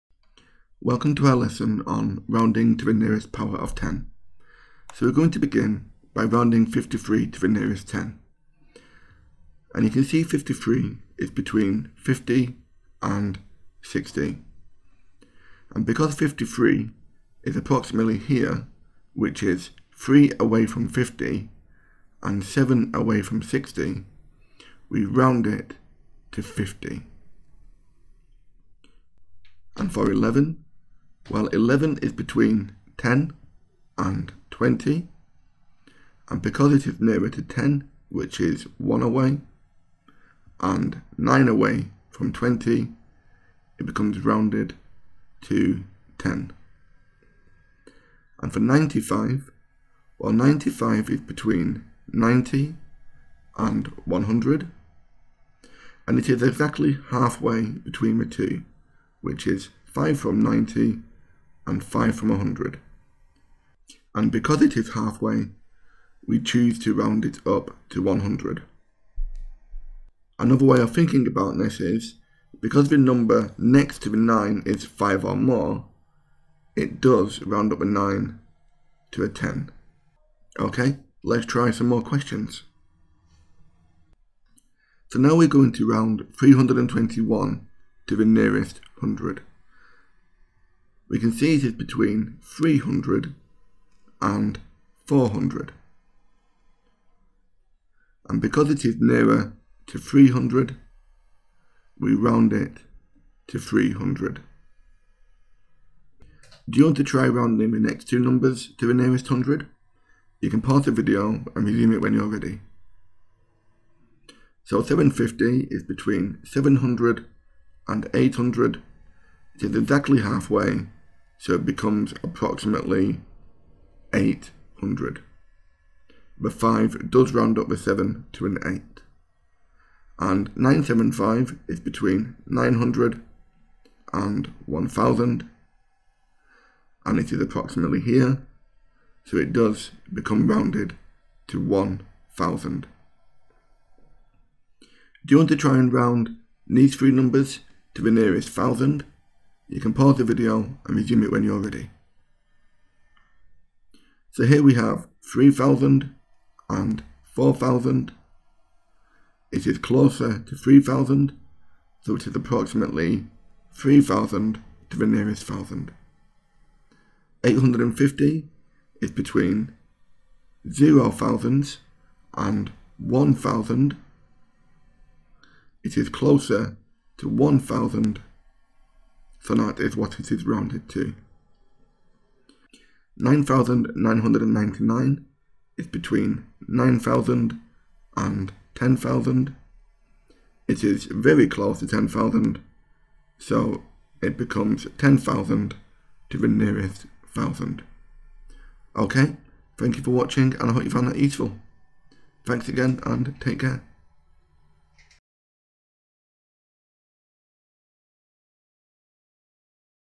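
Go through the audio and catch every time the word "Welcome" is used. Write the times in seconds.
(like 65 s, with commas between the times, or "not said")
0 s.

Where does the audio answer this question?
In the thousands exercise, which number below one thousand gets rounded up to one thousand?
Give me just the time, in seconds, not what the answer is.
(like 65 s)
167 s.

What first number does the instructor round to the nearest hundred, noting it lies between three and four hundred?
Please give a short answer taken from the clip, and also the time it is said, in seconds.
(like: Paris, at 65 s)
321, at 86 s.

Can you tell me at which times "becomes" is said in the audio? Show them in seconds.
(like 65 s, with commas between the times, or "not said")
43 s, 121 s, 140 s, 194 s.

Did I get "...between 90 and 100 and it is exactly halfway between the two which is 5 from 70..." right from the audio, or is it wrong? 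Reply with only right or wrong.
wrong.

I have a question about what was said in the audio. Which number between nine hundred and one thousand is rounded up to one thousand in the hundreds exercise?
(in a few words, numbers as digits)
975.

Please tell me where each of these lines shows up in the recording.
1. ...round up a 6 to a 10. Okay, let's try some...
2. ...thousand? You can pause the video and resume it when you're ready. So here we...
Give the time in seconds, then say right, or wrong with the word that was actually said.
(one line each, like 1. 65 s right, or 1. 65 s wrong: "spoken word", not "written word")
1. 77 s wrong: "9", not "6"
2. 148 s right.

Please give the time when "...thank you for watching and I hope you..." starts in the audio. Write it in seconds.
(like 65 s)
199 s.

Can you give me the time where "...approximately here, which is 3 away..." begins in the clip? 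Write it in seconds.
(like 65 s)
17 s.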